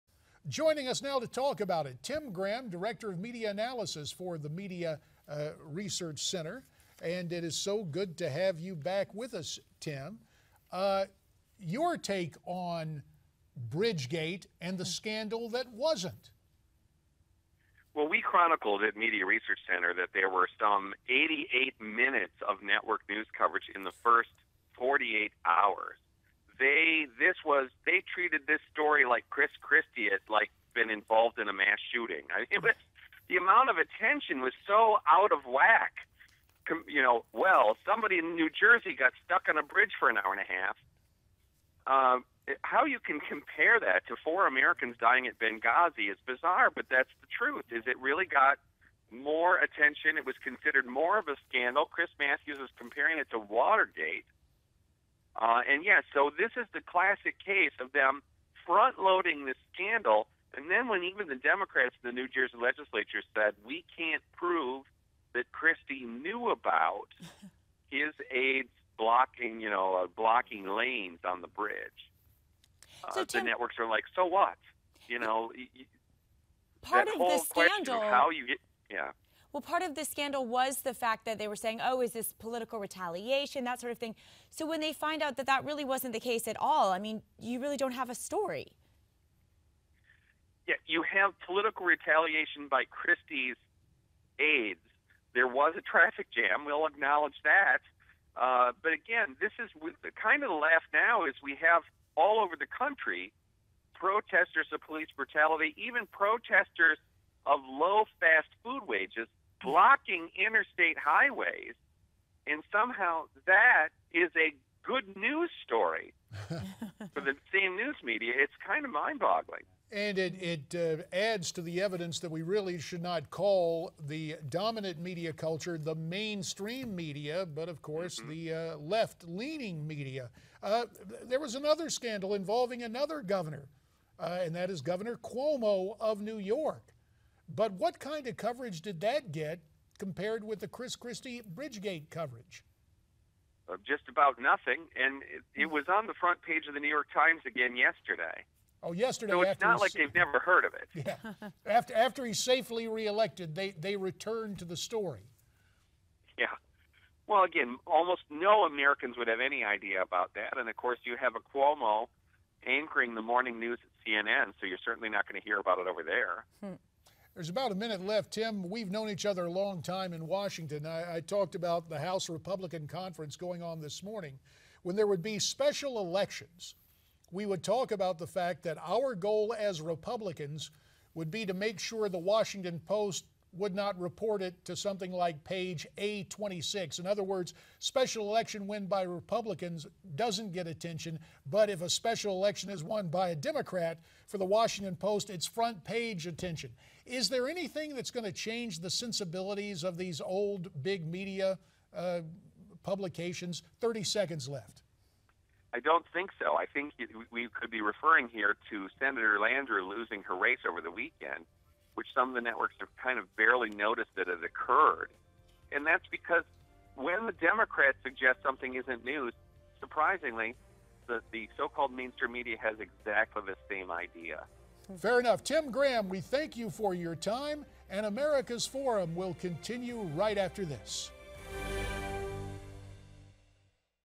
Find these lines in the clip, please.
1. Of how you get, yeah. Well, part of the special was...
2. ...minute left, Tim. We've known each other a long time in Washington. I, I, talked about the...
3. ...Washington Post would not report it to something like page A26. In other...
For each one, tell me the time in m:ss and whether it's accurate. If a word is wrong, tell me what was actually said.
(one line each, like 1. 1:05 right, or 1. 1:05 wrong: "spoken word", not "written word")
1. 1:17 wrong: "scandal", not "special"
2. 2:47 right
3. 3:02 right.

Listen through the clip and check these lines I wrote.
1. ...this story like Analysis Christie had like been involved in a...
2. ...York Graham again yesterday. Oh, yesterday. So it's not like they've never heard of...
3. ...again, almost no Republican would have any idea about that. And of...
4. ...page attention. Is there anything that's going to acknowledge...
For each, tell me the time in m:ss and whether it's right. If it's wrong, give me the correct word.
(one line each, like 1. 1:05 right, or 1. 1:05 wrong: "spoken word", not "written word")
1. 0:28 wrong: "Chris", not "Analysis"
2. 2:26 wrong: "Times", not "Graham"
3. 2:37 wrong: "Americans", not "Republican"
4. 3:15 wrong: "change", not "acknowledge".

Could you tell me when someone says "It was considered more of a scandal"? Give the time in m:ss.
0:50.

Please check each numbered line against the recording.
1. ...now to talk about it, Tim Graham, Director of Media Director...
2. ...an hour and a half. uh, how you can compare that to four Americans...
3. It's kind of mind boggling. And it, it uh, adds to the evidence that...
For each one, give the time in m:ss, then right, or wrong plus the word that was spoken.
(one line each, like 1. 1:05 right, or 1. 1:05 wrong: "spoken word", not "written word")
1. 0:01 wrong: "Analysis", not "Director"
2. 0:40 right
3. 1:58 right.